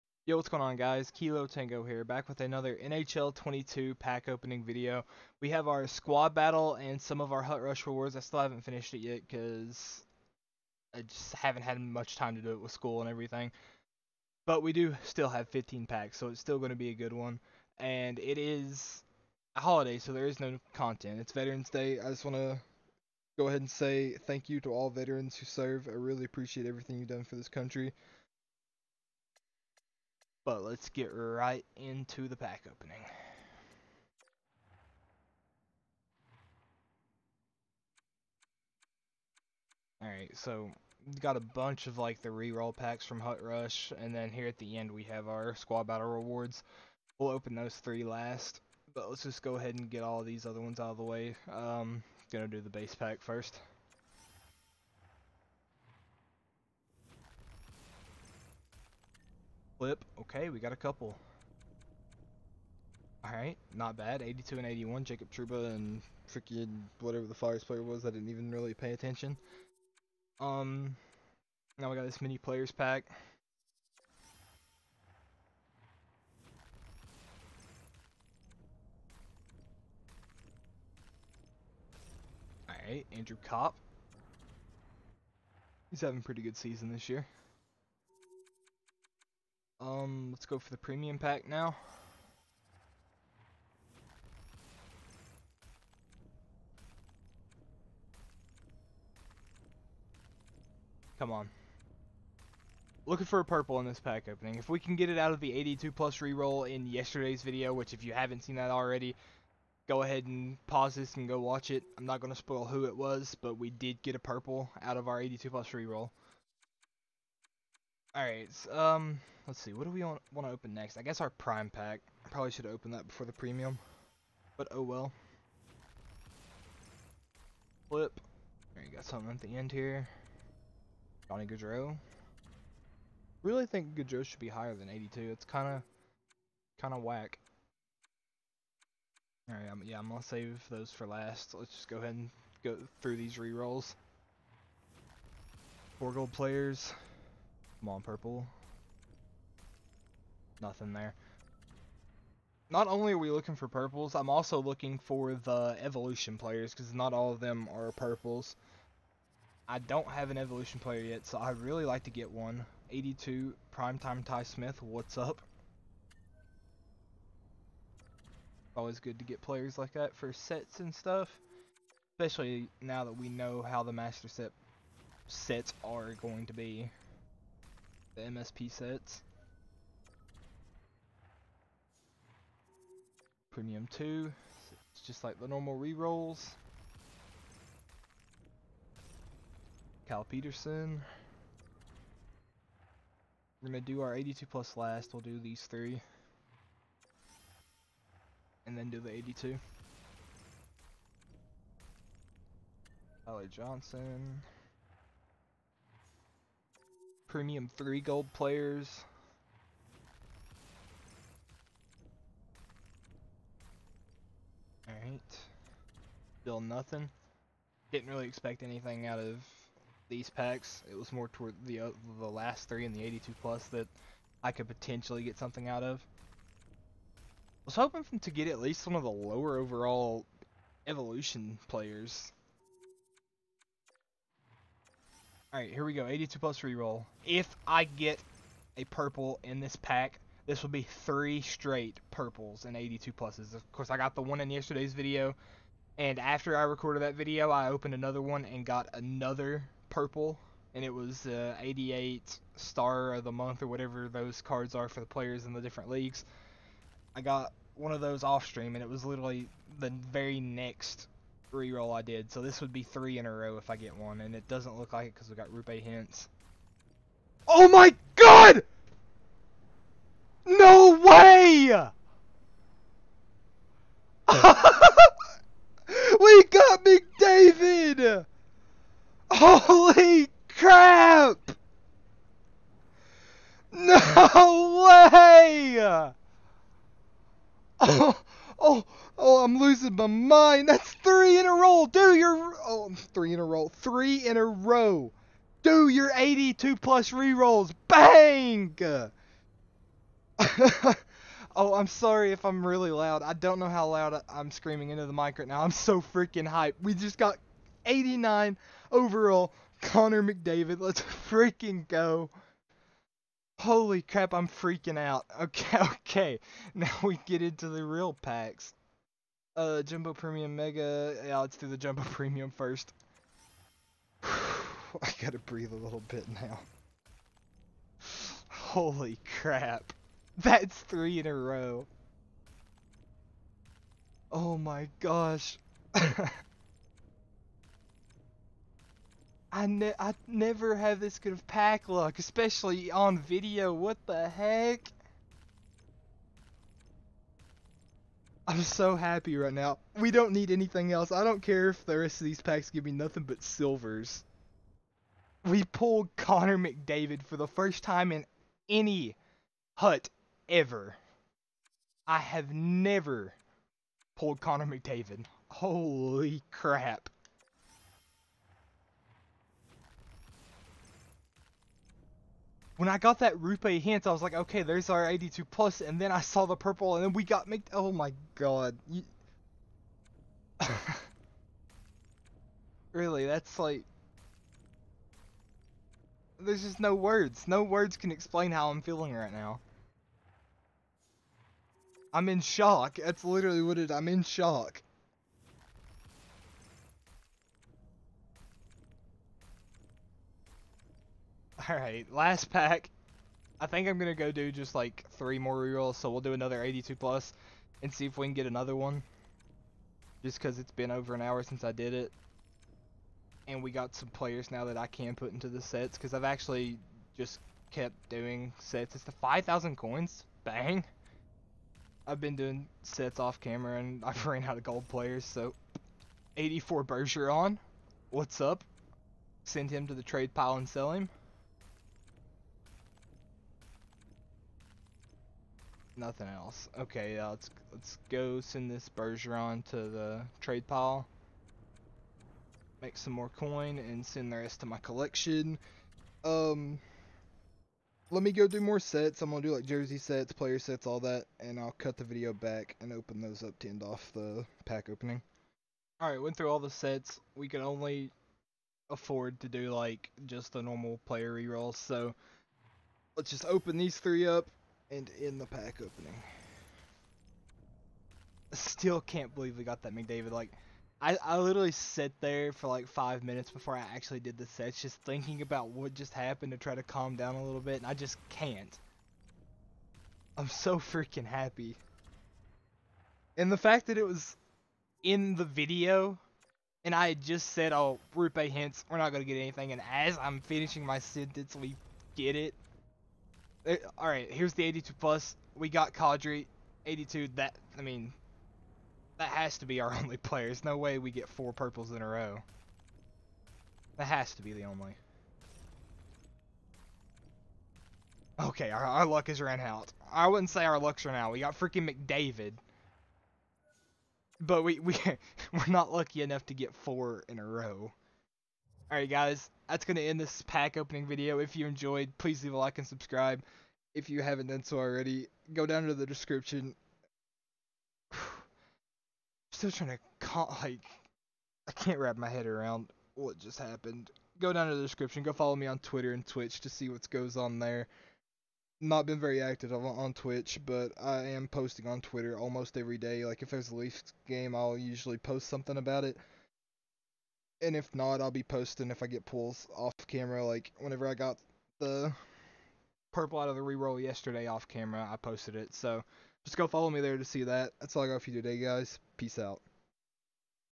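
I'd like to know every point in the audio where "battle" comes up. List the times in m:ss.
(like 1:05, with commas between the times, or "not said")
0:06, 0:45.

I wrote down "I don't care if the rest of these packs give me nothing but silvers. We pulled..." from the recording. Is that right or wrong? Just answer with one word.
right.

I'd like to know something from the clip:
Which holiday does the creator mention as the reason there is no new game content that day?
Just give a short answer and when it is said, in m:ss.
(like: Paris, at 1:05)
Veterans Day, at 0:21.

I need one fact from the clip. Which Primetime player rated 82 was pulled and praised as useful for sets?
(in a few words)
Ty Smith.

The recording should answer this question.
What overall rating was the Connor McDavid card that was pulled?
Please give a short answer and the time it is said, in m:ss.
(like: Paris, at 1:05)
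89, at 5:07.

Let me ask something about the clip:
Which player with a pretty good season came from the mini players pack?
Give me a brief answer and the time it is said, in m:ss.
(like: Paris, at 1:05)
Andrew Copp, at 1:23.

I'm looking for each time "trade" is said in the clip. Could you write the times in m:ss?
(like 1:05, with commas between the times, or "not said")
7:10, 7:20.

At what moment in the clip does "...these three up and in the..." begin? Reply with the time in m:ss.
7:43.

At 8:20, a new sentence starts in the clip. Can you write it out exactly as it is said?
There's no way we get four purples in a row.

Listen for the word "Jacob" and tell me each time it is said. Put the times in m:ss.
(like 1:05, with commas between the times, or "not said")
1:05.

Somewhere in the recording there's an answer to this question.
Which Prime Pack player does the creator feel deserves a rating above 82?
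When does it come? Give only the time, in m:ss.
2:11.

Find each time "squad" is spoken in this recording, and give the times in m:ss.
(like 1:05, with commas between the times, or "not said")
0:05, 0:45.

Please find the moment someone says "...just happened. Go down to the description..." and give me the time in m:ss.
8:53.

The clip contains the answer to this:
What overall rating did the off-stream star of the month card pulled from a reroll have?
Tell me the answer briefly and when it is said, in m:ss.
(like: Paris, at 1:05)
88, at 4:11.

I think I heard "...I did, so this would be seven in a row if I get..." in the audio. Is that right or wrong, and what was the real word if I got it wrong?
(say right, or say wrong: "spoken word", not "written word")
wrong: "three", not "seven".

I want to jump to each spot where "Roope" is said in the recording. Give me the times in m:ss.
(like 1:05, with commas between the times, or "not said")
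4:25, 6:13, 8:08.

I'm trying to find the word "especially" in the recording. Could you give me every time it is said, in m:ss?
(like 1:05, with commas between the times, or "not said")
2:52, 5:42.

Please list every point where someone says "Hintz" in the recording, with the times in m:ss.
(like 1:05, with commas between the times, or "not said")
4:25, 6:13, 8:08.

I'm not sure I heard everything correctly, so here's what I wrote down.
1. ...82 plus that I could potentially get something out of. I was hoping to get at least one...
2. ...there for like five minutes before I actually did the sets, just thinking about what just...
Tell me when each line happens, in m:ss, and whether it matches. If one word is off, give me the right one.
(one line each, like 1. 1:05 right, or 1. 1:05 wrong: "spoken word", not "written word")
1. 3:43 right
2. 7:52 right.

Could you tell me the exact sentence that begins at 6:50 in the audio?
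Just because it's been over an hour since I did it.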